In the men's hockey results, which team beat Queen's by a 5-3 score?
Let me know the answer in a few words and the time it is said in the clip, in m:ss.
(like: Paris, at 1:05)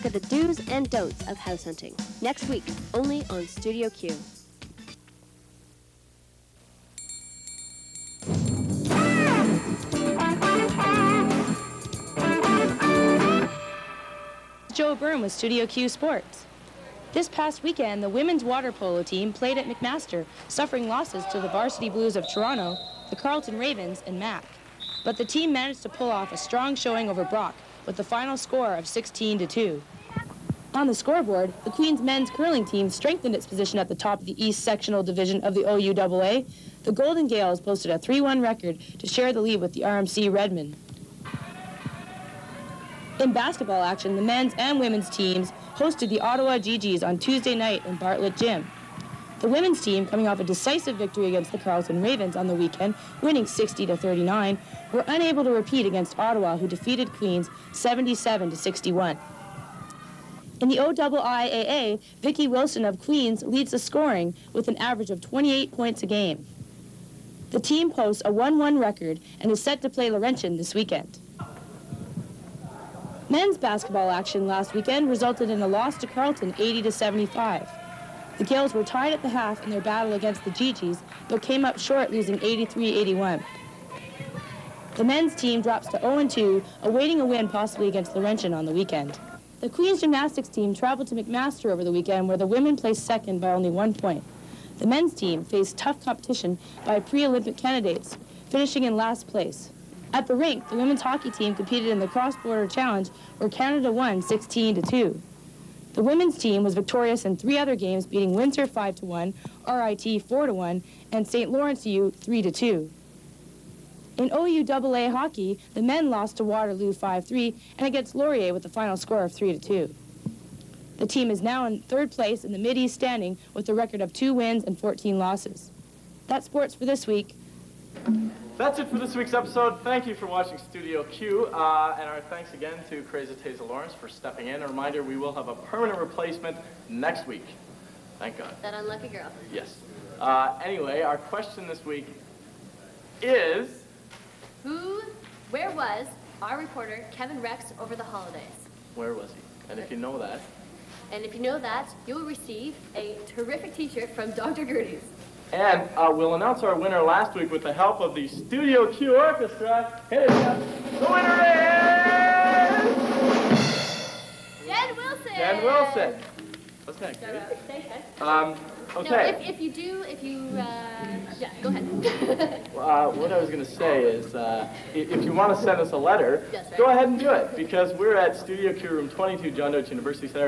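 Waterloo, at 1:56.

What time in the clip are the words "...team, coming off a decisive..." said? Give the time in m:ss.
0:49.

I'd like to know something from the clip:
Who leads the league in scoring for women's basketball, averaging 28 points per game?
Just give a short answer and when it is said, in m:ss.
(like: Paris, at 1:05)
Vicki Wilson, at 1:02.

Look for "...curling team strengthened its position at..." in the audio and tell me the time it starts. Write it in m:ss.
0:32.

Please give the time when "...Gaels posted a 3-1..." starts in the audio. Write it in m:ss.
0:37.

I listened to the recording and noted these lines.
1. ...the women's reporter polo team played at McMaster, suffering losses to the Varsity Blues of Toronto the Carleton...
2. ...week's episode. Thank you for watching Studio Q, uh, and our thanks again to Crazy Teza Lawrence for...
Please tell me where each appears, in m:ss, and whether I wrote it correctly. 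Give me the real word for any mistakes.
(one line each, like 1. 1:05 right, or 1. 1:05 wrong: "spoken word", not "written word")
1. 0:18 wrong: "water", not "reporter"
2. 2:09 right.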